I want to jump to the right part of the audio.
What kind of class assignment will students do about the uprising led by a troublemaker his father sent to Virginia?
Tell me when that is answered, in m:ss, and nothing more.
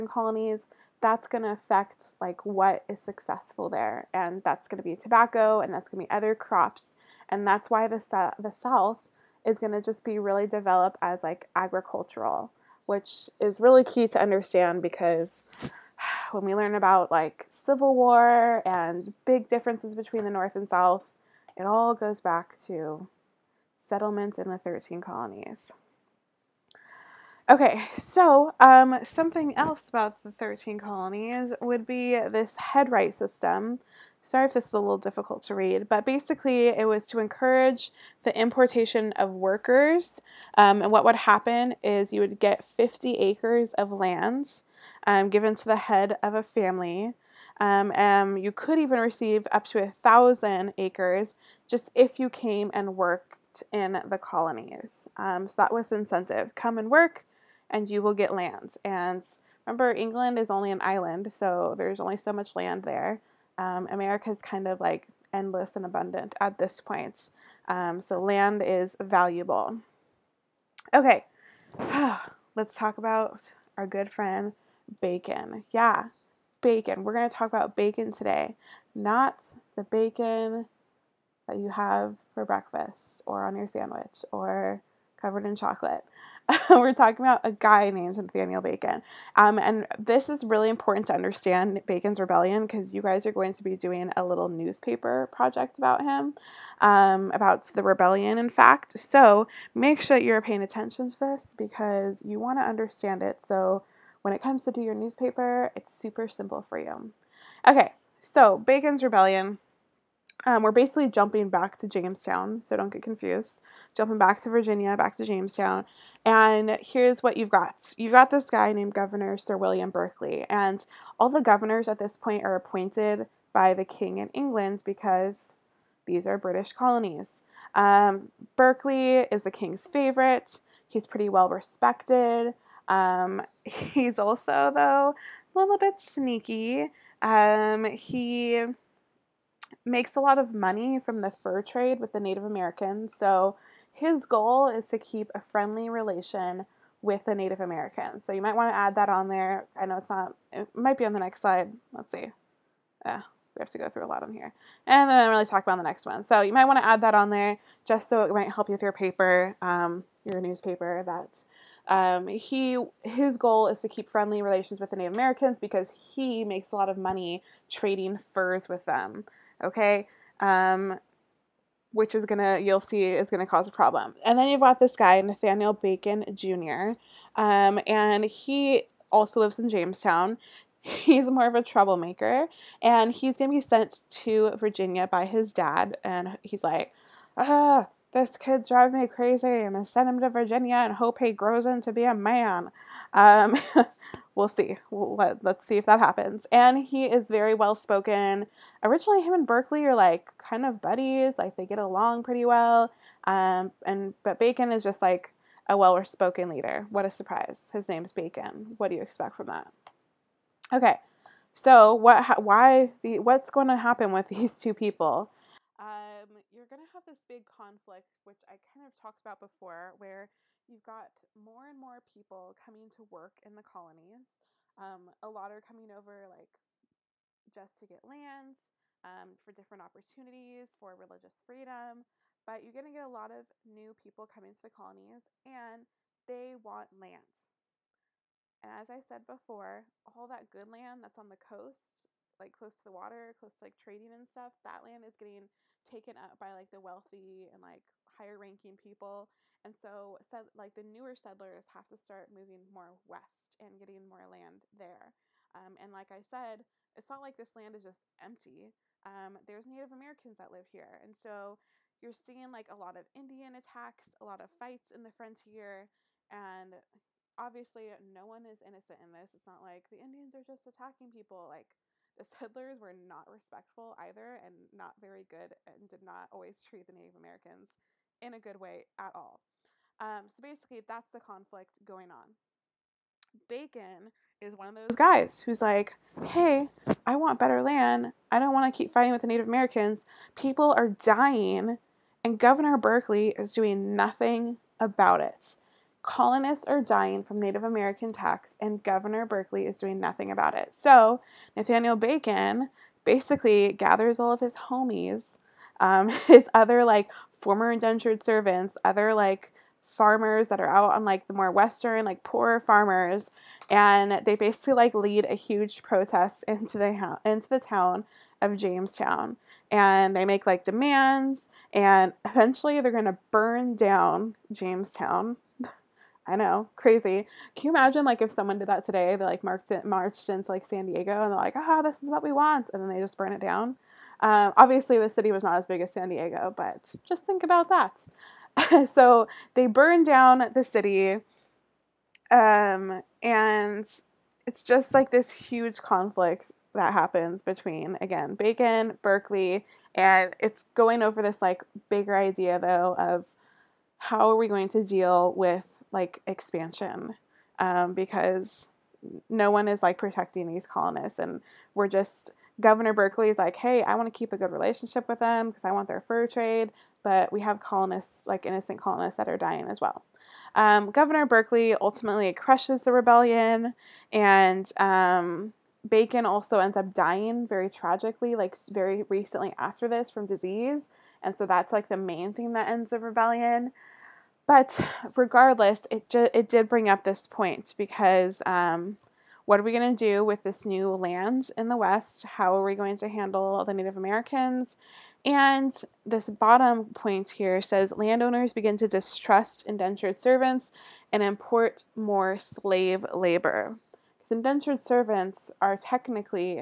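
1:34.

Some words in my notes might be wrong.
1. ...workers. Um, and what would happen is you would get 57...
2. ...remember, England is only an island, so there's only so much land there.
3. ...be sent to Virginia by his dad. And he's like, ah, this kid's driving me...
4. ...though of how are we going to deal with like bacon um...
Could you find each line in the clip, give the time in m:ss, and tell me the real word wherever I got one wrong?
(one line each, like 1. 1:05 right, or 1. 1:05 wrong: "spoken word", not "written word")
1. 0:39 wrong: "50", not "57"
2. 0:59 right
3. 3:03 right
4. 5:52 wrong: "expansion", not "bacon".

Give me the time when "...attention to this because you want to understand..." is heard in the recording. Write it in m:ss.
1:40.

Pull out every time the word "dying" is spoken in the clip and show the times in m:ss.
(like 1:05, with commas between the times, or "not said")
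4:51, 4:56, 6:09, 6:16.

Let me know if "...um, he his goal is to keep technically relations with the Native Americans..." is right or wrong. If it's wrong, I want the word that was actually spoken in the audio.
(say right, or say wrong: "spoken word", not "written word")
wrong: "friendly", not "technically".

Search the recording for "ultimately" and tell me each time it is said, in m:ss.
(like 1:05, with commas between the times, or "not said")
6:11.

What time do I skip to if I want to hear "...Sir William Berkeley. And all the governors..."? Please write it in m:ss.
1:59.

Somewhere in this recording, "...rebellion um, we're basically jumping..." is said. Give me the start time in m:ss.
1:49.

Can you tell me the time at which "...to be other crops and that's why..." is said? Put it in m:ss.
0:06.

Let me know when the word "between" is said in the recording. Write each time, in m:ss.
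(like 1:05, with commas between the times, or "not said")
0:19, 5:47.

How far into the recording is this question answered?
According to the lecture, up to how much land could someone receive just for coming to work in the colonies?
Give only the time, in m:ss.
0:49.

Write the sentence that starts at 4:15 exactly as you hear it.
Um, and like I said, it's not like this land is just empty.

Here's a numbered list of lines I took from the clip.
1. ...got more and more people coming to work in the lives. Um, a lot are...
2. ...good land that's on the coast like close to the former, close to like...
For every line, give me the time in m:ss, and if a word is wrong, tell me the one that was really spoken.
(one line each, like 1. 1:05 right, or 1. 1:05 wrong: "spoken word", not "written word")
1. 3:40 wrong: "colonies", not "lives"
2. 4:00 wrong: "water", not "former".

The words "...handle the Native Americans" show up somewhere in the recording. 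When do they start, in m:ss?
6:33.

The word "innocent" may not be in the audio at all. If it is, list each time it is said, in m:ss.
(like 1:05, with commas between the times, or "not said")
4:28, 6:08.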